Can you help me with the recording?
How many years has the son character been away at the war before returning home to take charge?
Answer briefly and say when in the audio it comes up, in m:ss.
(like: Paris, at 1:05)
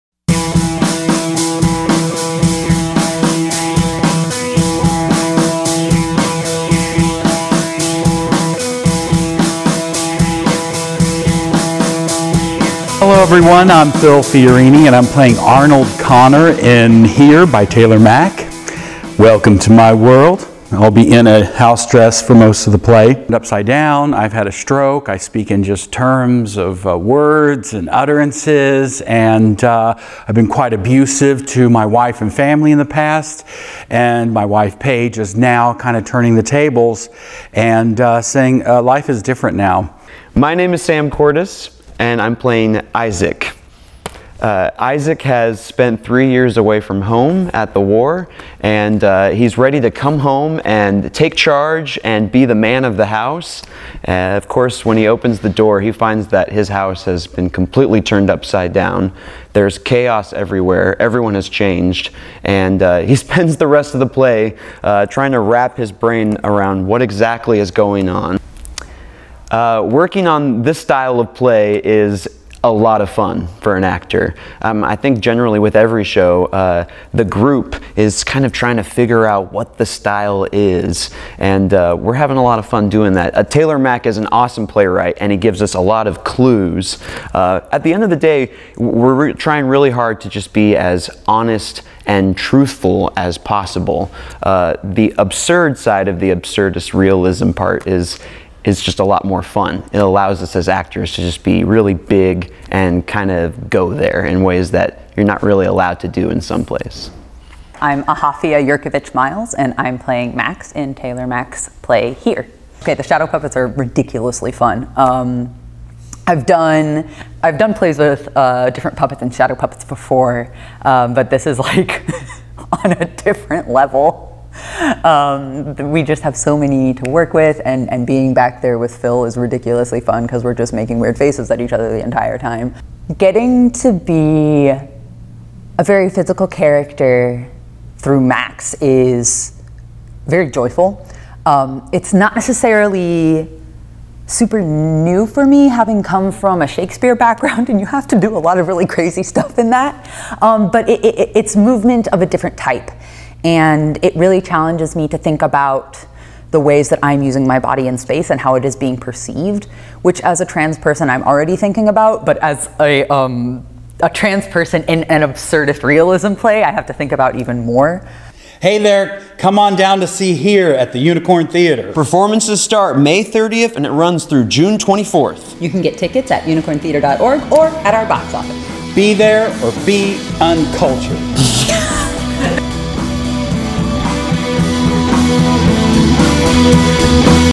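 3, at 0:46.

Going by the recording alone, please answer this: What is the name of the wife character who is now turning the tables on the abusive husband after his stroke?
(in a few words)
Paige.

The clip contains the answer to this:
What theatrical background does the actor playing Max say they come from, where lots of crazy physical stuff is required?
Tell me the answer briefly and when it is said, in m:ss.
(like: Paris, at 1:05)
Shakespeare, at 2:26.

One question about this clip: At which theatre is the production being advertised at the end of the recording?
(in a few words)
Unicorn Theatre.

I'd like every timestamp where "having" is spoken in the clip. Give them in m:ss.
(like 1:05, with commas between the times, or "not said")
1:22, 2:25.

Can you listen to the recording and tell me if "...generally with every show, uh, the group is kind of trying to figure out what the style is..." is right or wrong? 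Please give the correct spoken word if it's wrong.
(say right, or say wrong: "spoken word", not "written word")
right.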